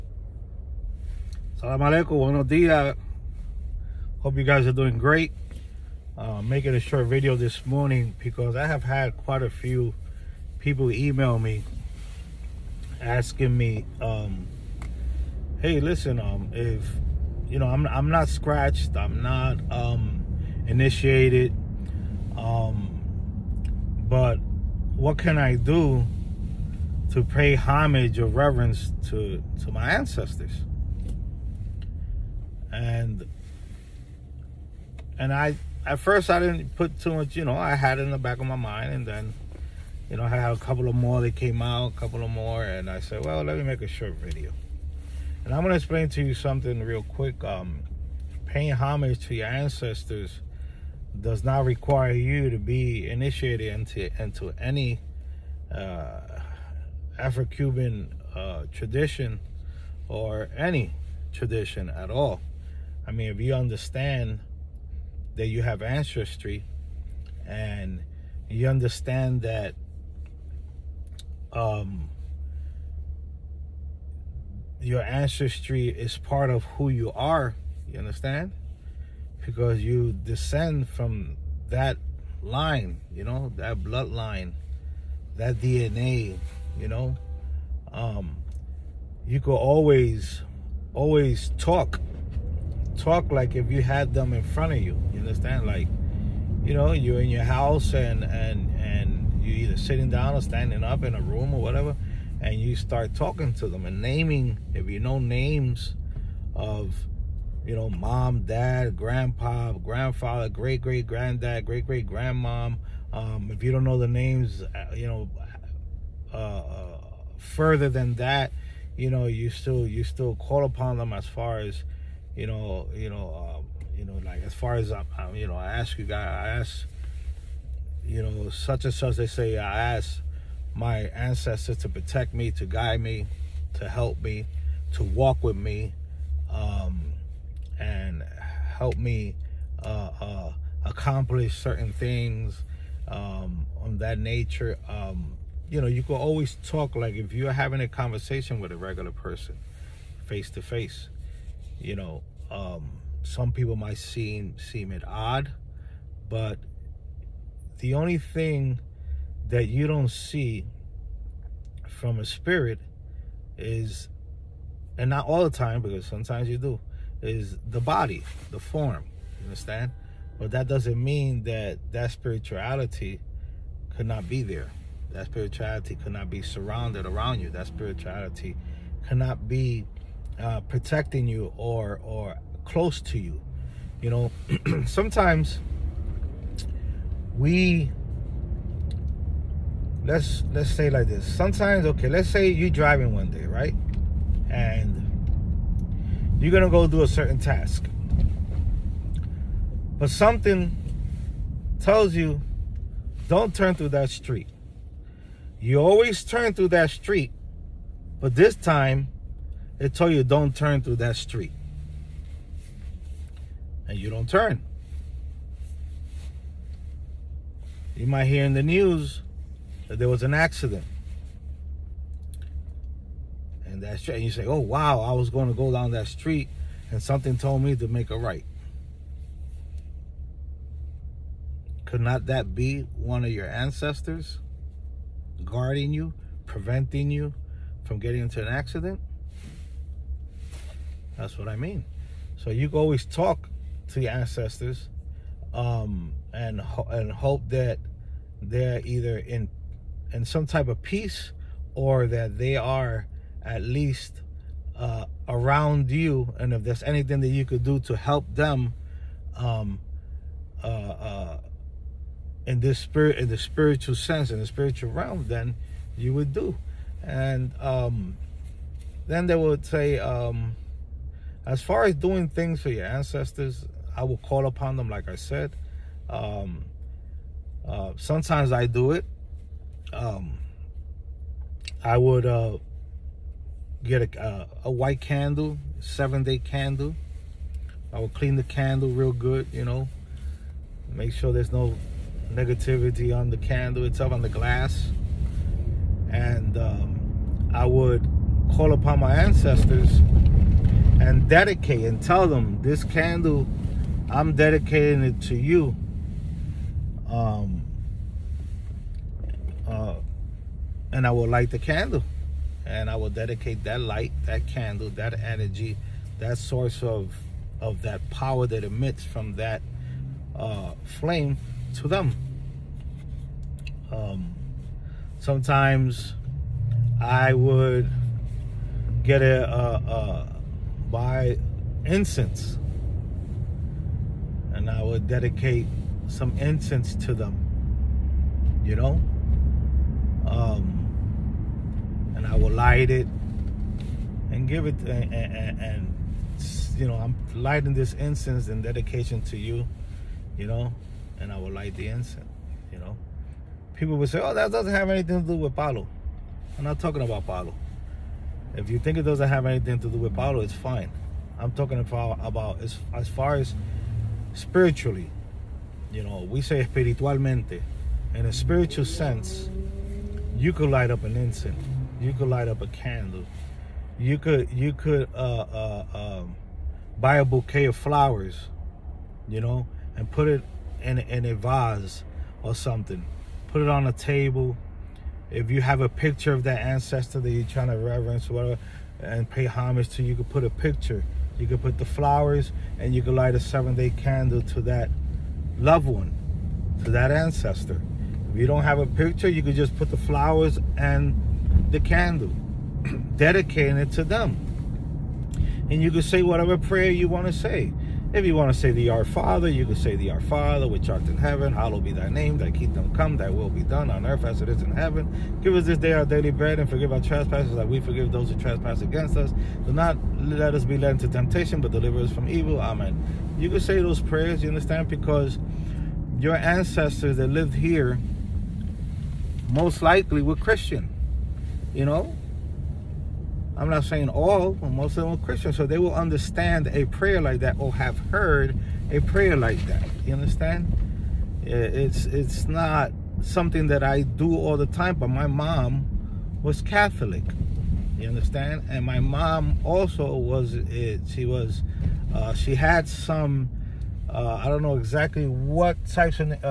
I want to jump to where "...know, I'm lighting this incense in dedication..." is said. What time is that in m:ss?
5:46.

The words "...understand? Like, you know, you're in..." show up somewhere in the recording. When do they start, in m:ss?
1:35.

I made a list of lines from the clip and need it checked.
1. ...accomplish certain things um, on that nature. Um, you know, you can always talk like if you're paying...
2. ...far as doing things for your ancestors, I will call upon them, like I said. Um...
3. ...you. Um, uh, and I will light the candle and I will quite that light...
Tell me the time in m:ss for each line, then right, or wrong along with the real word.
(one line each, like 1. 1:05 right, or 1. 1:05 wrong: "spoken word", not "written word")
1. 2:20 wrong: "having", not "paying"
2. 4:31 right
3. 5:05 wrong: "dedicate", not "quite".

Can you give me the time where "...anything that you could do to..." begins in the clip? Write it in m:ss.
4:16.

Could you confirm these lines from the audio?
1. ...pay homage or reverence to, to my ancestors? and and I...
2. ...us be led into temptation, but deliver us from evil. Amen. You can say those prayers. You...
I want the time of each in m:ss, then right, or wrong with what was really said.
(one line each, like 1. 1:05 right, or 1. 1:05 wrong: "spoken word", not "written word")
1. 0:27 right
2. 7:00 right.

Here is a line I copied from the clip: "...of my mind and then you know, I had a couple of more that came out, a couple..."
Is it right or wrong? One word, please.
right.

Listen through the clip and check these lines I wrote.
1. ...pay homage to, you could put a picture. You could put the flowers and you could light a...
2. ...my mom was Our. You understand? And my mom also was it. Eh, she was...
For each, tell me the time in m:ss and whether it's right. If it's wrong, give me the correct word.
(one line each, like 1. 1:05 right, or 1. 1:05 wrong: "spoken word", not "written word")
1. 6:29 right
2. 7:25 wrong: "Catholic", not "Our".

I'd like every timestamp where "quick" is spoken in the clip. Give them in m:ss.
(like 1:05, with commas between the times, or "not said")
0:47.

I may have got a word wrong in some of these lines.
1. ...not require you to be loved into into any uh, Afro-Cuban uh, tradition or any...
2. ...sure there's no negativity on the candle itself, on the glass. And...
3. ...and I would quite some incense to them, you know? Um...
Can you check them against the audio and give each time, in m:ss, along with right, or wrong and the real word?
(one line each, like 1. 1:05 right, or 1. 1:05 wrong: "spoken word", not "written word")
1. 0:51 wrong: "initiated", not "loved"
2. 4:51 right
3. 5:34 wrong: "dedicate", not "quite".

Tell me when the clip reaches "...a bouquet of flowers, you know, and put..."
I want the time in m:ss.
6:17.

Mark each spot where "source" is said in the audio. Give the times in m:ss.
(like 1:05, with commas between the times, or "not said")
5:16.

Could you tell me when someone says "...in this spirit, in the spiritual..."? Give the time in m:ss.
4:22.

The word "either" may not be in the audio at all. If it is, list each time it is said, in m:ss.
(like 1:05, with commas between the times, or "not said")
1:39, 4:08.